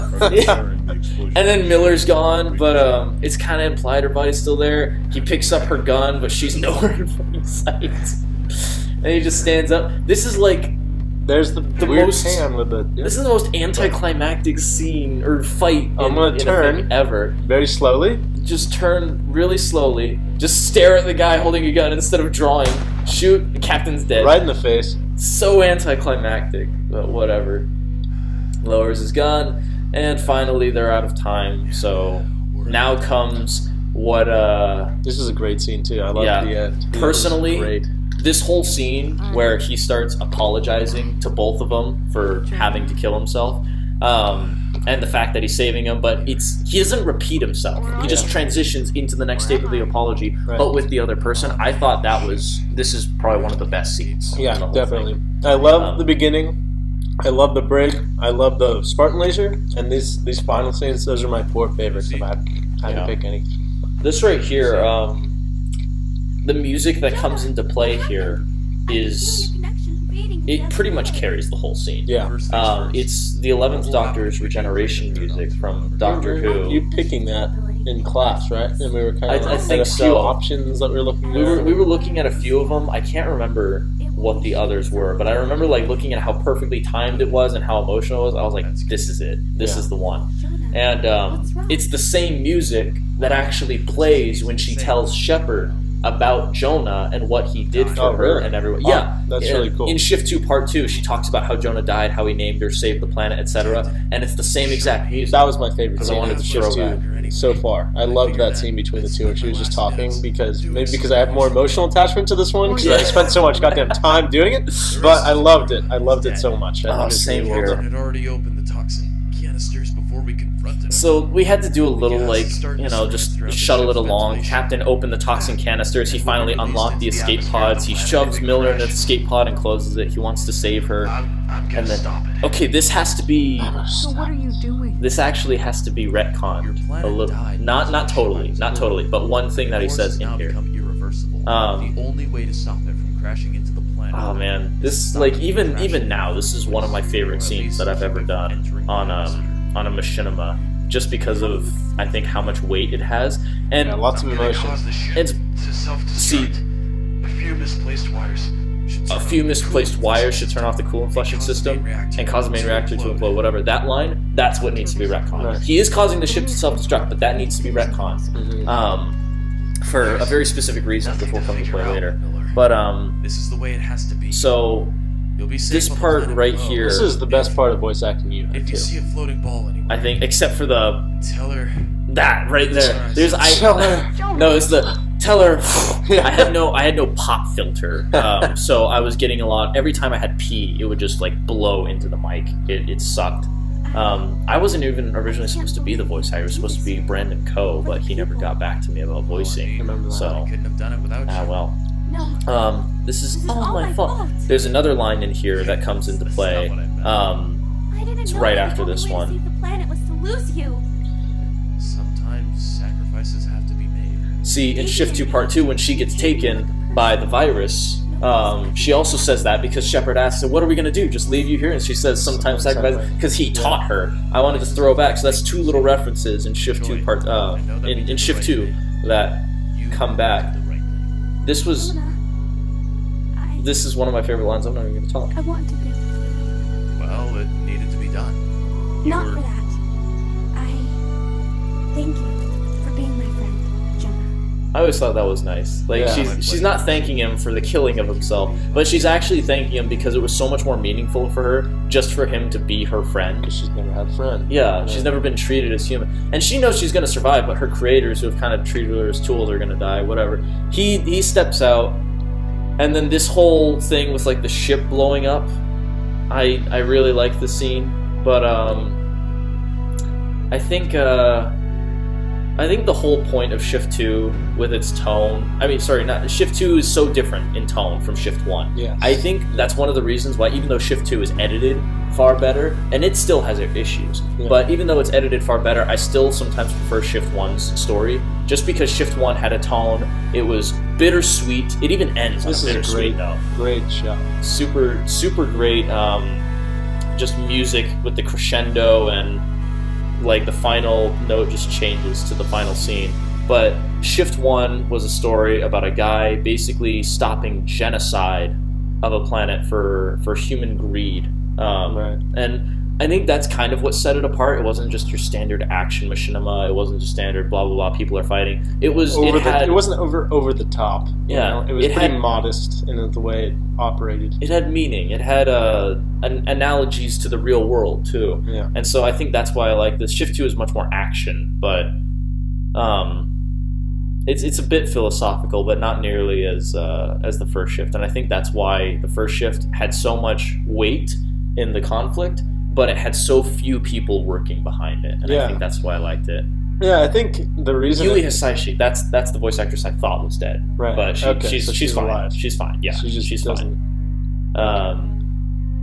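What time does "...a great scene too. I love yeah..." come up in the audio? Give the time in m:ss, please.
0:35.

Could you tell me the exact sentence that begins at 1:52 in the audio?
I spent so much goddamn time doing it.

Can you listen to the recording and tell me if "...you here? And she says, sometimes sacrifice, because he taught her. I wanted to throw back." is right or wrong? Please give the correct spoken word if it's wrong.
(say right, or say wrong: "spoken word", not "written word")
right.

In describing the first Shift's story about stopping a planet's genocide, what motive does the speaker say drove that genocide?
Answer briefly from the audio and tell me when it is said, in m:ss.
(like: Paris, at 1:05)
Human greed, at 5:10.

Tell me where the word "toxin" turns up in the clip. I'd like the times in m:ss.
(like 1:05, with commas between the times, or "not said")
1:58, 2:05.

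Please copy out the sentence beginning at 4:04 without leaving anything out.
I always thought that was nice.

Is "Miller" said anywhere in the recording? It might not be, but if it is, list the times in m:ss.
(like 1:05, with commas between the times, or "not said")
0:01, 2:08, 2:52.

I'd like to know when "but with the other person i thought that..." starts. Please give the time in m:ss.
0:50.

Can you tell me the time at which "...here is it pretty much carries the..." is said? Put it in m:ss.
1:08.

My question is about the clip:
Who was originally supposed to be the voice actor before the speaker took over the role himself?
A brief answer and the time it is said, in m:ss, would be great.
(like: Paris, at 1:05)
Brandon Coe, at 3:16.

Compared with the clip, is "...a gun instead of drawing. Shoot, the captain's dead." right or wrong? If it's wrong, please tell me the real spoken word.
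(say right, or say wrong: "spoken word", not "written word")
right.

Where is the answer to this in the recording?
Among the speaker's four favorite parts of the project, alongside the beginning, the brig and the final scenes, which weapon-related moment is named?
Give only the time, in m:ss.
0:58.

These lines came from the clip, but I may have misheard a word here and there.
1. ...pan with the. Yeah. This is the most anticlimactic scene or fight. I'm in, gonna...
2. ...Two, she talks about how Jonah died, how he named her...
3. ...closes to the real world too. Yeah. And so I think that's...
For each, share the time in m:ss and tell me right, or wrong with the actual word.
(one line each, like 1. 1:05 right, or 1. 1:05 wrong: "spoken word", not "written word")
1. 0:12 right
2. 1:40 right
3. 5:26 wrong: "analogies", not "closes".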